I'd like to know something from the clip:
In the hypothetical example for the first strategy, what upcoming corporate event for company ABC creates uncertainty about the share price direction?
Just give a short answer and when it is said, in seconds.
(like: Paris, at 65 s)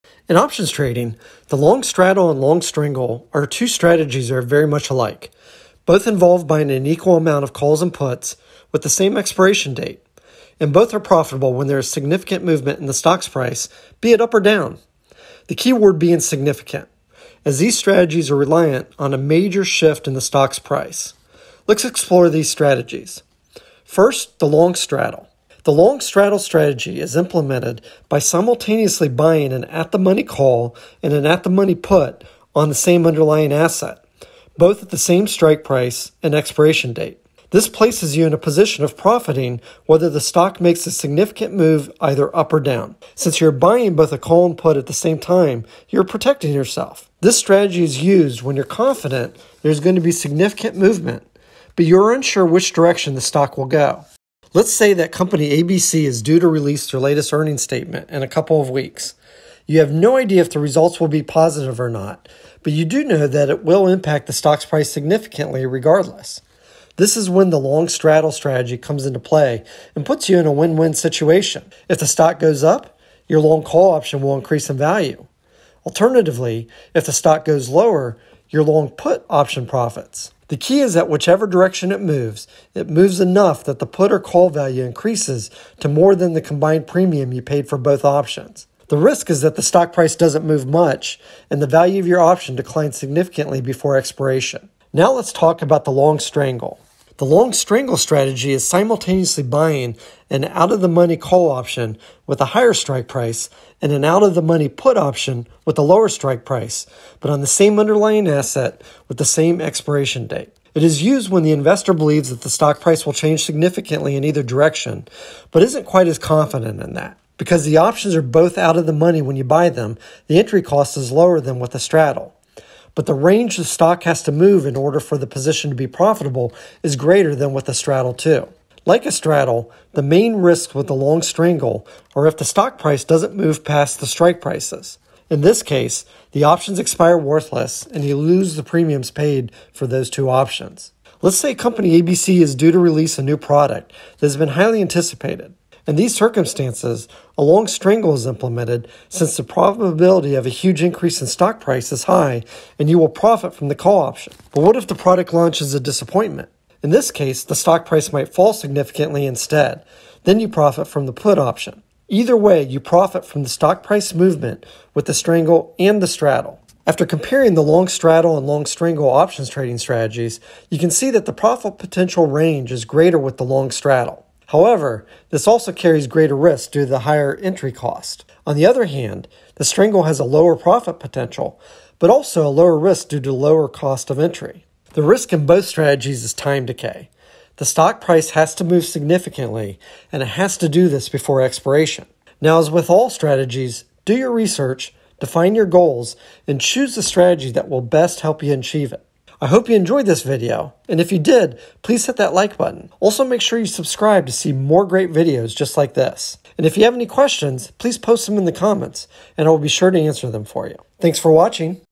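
earnings statement, at 57 s.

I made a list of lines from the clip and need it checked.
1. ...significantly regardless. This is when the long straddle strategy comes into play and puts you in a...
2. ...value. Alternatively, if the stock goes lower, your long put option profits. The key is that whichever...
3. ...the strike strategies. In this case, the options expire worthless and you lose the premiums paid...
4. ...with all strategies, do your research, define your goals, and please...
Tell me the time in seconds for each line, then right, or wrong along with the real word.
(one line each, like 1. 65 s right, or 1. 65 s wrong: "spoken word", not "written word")
1. 64 s right
2. 74 s right
3. 133 s wrong: "prices", not "strategies"
4. 192 s wrong: "choose", not "please".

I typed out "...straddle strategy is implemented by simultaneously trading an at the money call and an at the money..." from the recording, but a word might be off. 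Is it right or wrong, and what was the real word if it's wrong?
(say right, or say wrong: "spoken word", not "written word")
wrong: "buying", not "trading".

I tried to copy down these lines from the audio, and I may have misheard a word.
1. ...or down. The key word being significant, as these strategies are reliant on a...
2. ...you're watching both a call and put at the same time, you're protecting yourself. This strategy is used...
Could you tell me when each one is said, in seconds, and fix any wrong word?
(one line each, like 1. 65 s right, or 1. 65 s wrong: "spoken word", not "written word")
1. 14 s right
2. 43 s wrong: "buying", not "watching".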